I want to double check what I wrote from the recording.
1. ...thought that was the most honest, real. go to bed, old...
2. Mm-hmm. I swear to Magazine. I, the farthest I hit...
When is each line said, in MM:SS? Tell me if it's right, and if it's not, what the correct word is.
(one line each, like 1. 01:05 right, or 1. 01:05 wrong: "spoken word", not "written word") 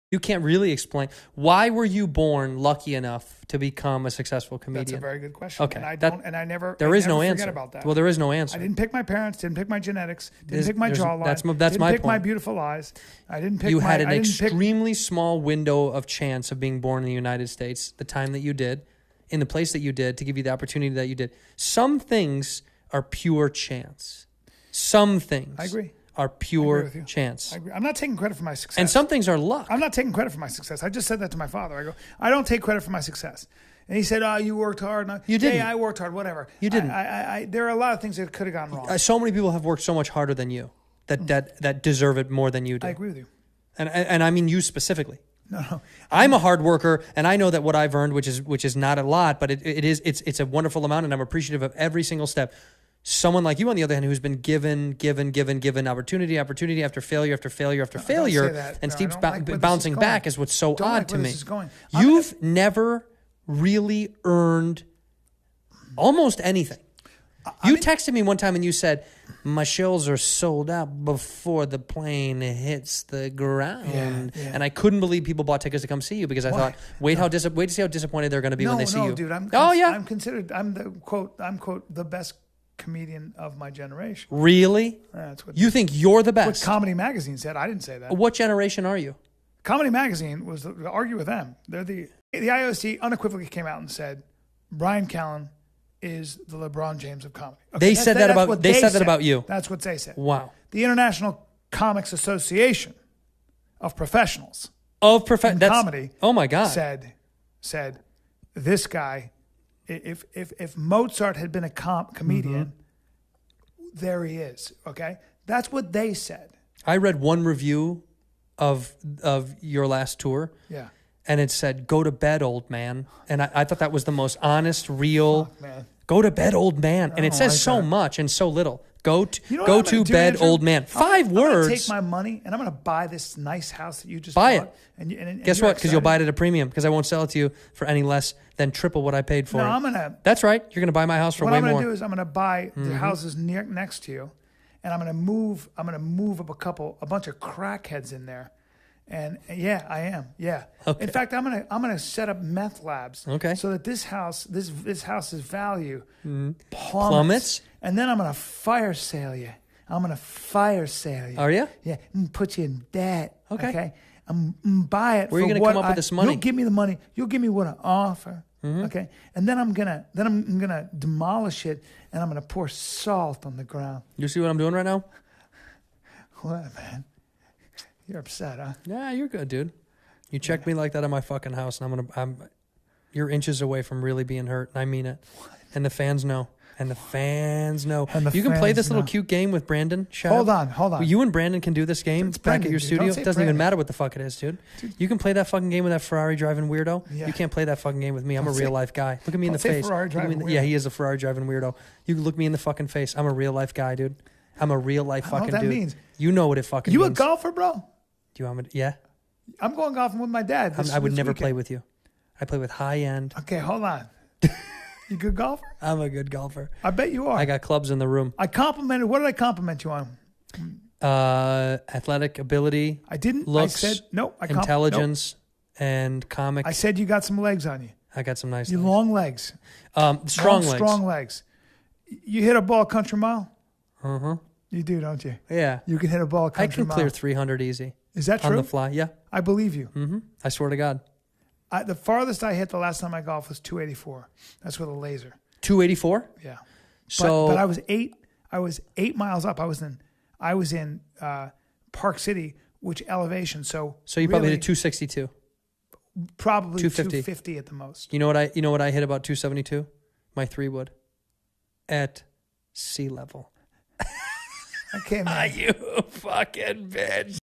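1. 02:03 right
2. 03:59 wrong: "God", not "Magazine".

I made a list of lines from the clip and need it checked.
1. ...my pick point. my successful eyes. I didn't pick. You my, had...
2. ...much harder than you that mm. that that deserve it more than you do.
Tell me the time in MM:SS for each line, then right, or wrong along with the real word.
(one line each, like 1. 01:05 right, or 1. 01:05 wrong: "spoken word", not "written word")
1. 00:11 wrong: "beautiful", not "successful"
2. 00:39 right.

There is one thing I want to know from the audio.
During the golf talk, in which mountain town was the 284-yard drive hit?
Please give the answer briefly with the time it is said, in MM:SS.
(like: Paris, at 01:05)
Park City, at 04:11.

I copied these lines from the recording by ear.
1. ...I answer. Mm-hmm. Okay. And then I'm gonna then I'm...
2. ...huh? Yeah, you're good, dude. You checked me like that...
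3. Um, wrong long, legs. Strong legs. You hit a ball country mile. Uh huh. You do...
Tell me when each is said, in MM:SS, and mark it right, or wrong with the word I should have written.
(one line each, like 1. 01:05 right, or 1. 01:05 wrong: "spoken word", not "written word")
1. 02:47 wrong: "offer", not "answer"
2. 02:58 right
3. 03:49 wrong: "strong", not "wrong".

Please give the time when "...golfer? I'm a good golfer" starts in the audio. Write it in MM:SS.
03:35.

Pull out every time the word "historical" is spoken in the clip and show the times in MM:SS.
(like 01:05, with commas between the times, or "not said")
not said.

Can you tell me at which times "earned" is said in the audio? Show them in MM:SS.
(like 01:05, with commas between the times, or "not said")
00:47, 01:04.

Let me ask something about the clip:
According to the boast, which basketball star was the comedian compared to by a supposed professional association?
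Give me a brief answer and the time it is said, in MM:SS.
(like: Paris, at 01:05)
LeBron James, at 01:36.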